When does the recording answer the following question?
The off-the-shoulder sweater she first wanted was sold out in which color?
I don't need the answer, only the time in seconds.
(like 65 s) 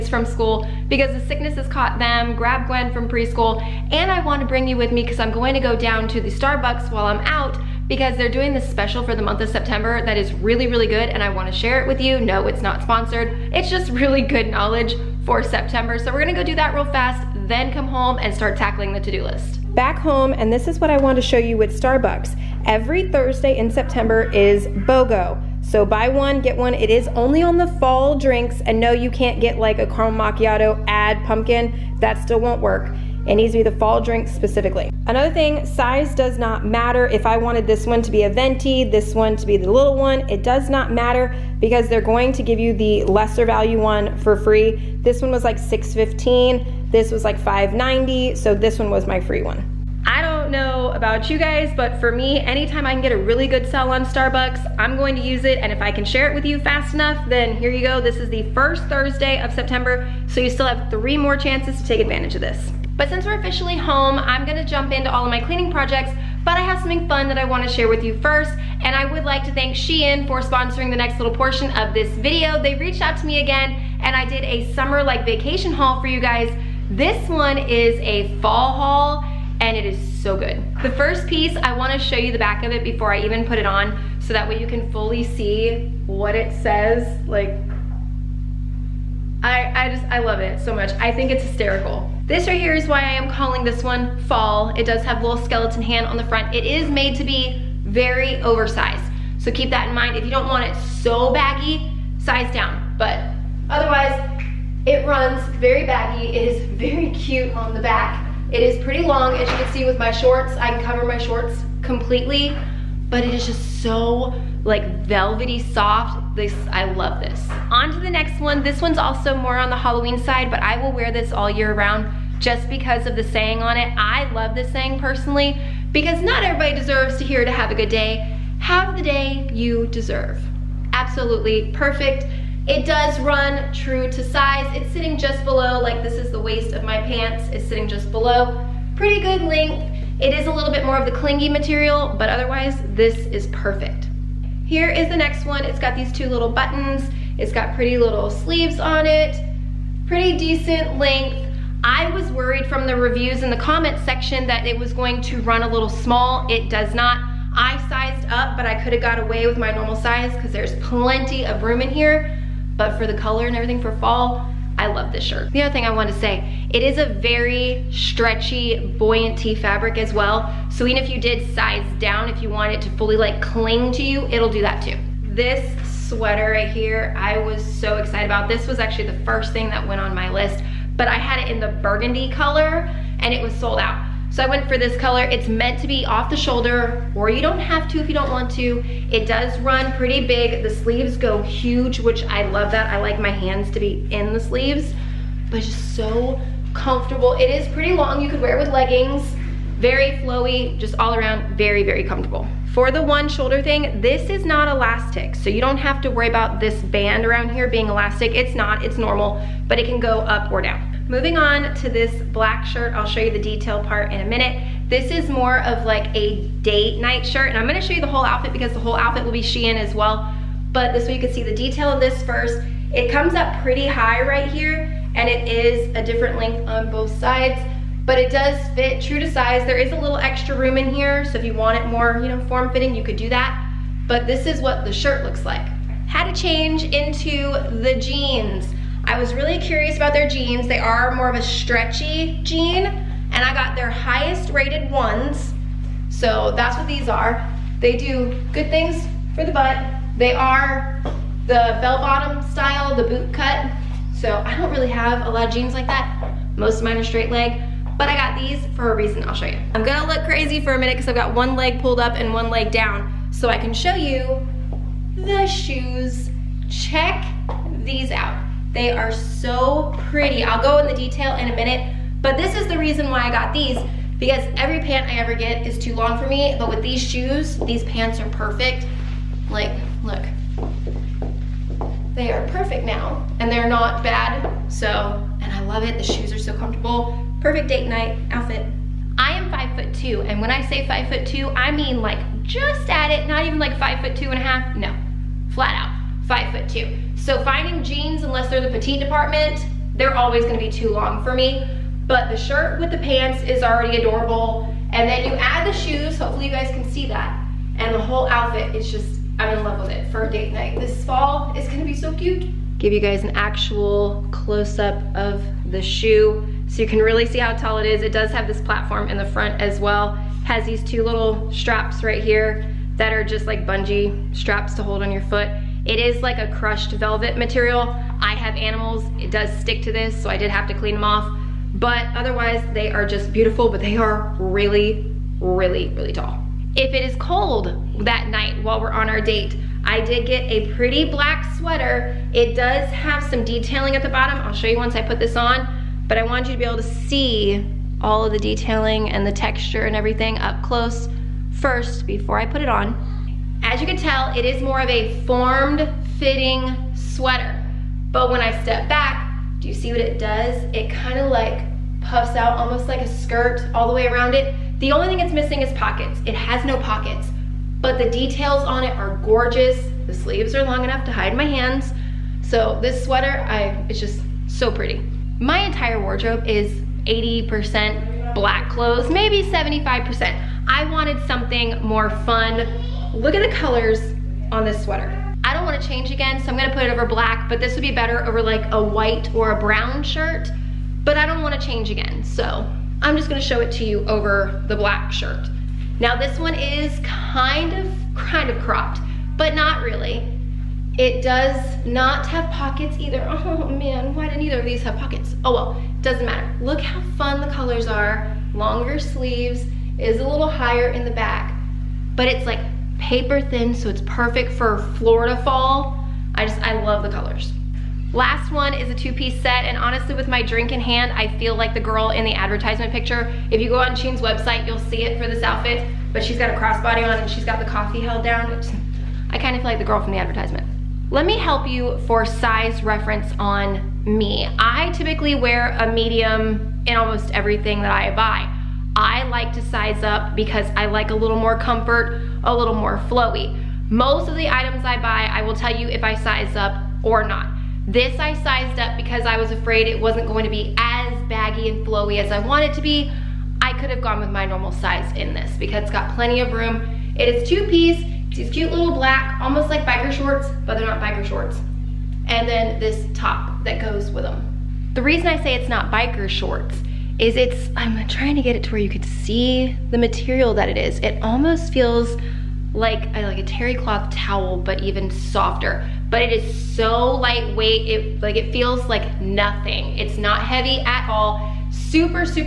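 181 s.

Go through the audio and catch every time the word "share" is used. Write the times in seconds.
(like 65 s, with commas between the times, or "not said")
11 s, 56 s, 67 s.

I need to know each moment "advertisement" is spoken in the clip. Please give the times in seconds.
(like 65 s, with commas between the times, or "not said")
422 s, 430 s.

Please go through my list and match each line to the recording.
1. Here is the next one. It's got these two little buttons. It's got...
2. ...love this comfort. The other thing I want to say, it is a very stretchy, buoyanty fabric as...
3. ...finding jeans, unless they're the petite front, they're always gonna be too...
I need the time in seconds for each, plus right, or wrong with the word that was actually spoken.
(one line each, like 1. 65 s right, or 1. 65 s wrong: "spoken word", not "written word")
1. 144 s right
2. 164 s wrong: "shirt", not "comfort"
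3. 297 s wrong: "department", not "front".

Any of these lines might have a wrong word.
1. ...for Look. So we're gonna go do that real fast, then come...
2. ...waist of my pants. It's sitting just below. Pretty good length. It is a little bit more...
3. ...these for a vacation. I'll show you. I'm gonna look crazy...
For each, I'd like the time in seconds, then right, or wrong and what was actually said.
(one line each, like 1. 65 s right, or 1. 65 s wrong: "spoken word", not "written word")
1. 15 s wrong: "September", not "Look"
2. 136 s right
3. 258 s wrong: "reason", not "vacation".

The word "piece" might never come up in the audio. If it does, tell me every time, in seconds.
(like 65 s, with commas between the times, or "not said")
81 s, 418 s, 457 s.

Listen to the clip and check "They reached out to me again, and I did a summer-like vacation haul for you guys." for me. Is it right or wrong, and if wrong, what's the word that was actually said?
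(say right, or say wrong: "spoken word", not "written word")
right.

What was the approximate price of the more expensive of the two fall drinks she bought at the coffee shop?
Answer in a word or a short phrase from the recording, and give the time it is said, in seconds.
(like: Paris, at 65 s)
6.15, at 45 s.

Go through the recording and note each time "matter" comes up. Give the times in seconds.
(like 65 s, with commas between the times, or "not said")
36 s, 40 s, 406 s.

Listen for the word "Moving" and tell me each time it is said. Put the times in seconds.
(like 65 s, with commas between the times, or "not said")
211 s.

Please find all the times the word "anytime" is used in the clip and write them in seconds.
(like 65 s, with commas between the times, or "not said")
52 s.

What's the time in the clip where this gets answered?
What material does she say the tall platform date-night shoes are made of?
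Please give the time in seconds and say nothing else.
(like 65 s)
326 s.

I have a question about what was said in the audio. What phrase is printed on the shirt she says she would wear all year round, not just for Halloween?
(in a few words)
Have the day you deserve.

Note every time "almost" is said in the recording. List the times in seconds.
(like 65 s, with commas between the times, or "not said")
362 s, 436 s, 459 s, 471 s.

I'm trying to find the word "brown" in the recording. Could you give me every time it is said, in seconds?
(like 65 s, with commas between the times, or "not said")
389 s.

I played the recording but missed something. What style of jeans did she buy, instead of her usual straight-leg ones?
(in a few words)
Bell bottom.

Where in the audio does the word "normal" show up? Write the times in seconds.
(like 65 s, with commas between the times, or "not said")
159 s, 208 s, 454 s.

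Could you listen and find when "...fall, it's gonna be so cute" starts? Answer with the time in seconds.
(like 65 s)
311 s.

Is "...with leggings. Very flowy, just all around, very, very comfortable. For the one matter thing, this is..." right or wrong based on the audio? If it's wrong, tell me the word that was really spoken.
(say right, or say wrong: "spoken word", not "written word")
wrong: "shoulder", not "matter".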